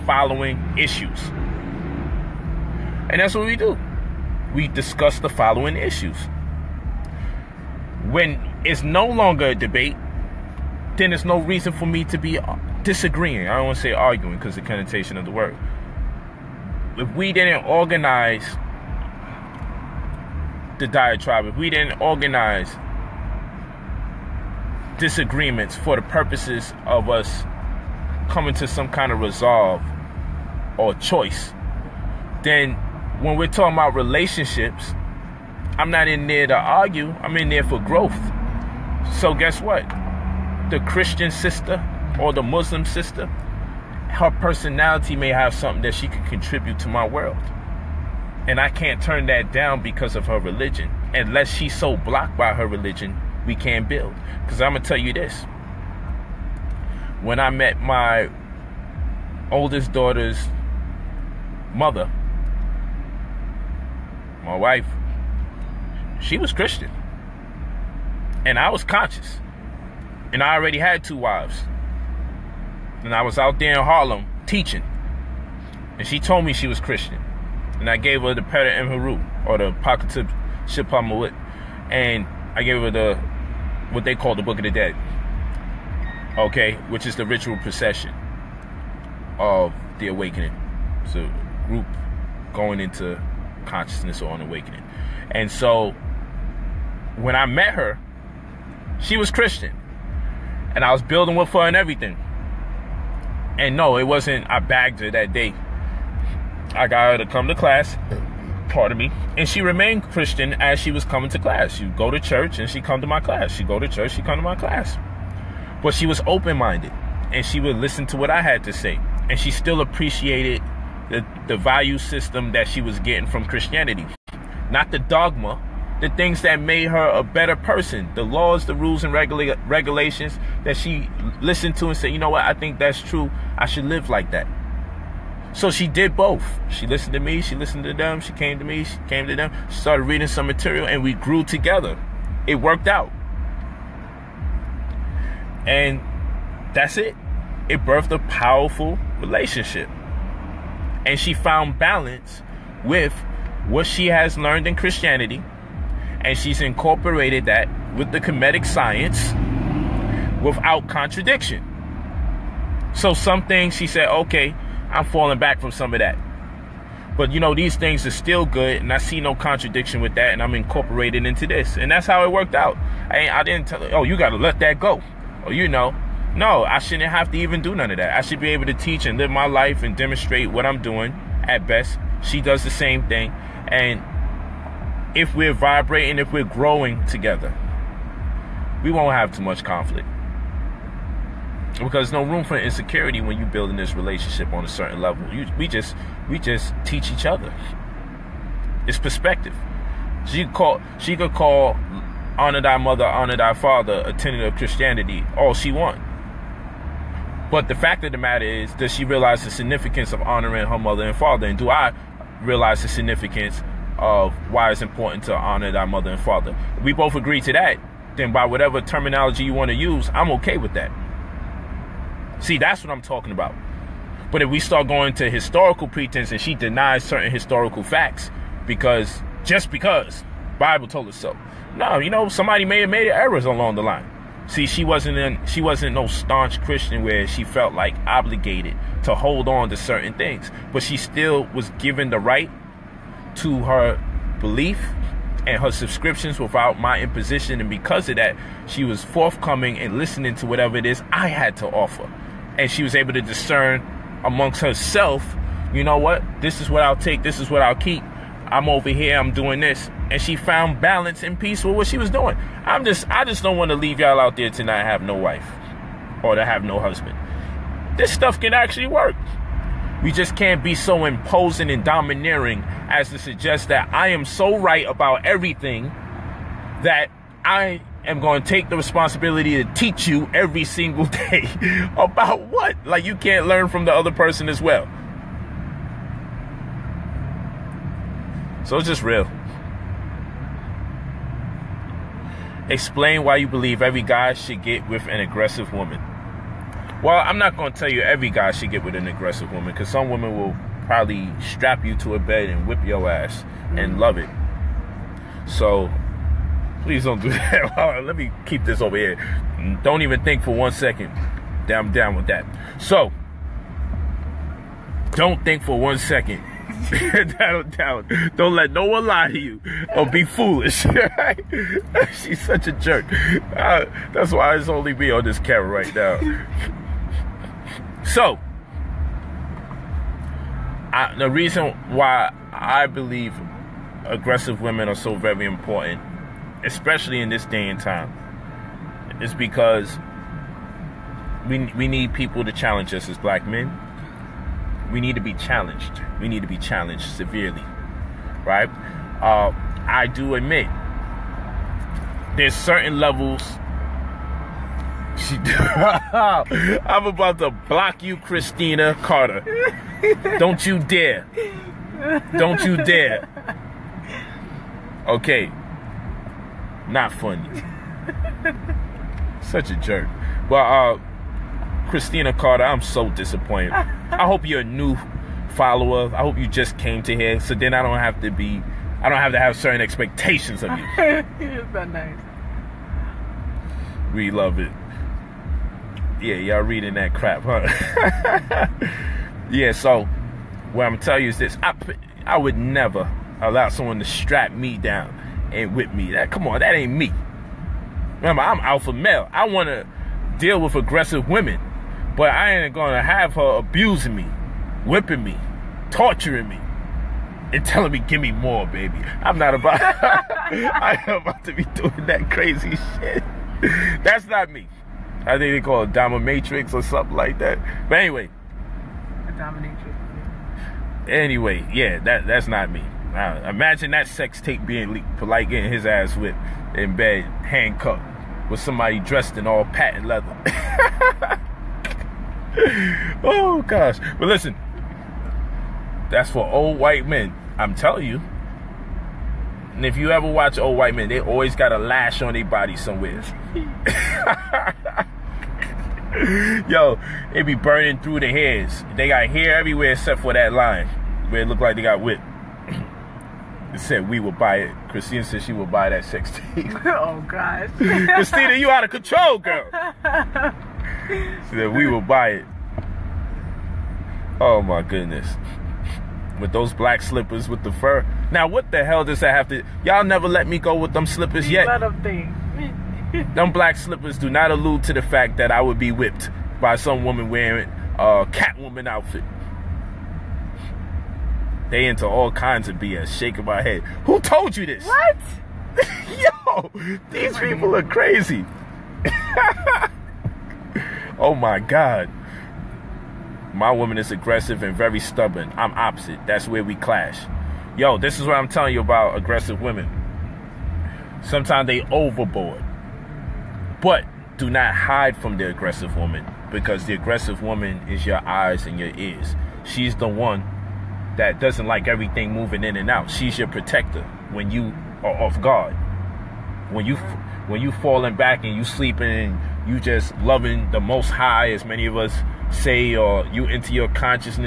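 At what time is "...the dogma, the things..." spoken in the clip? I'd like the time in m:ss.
2:04.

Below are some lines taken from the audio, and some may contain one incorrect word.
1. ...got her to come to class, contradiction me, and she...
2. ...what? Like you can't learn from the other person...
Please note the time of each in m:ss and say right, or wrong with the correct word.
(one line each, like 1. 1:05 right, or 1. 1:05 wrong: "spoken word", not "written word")
1. 1:46 wrong: "pardon", not "contradiction"
2. 4:42 right.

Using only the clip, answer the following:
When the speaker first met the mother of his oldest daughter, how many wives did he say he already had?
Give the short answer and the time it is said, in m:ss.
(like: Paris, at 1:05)
2, at 1:11.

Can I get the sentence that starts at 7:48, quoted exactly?
Now what the hell does that have to y'all never let me go with them slippers yet.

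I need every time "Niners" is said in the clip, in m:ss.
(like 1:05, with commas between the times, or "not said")
not said.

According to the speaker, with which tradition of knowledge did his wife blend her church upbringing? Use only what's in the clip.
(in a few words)
Kemetic science.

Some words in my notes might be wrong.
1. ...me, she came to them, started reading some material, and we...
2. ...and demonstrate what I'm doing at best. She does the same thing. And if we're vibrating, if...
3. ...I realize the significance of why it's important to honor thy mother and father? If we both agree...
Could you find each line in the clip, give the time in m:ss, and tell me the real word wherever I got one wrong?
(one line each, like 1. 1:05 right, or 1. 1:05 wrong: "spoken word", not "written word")
1. 2:18 right
2. 2:59 right
3. 3:31 right.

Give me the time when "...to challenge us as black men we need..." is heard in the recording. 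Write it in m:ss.
5:42.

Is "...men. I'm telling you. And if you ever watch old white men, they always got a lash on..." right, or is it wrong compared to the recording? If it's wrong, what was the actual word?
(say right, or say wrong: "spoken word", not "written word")
right.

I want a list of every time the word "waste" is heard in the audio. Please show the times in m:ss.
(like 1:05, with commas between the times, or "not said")
not said.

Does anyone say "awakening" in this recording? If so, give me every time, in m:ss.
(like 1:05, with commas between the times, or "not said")
1:30, 1:34.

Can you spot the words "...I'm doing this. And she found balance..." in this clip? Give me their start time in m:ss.
4:19.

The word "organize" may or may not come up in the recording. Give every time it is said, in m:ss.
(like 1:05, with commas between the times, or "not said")
0:17, 0:22.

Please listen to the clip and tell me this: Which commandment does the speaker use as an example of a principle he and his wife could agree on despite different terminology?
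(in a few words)
Honor thy mother and father.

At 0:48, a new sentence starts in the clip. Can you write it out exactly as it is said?
And I can't turn that down because of her religion.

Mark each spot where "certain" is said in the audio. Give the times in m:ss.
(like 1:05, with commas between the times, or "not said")
3:14, 3:47, 3:59, 5:52, 6:19.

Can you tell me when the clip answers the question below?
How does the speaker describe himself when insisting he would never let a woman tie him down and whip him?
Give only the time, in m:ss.
6:38.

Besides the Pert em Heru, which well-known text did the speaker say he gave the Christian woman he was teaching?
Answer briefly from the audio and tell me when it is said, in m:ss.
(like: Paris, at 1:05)
Book of the Dead, at 1:24.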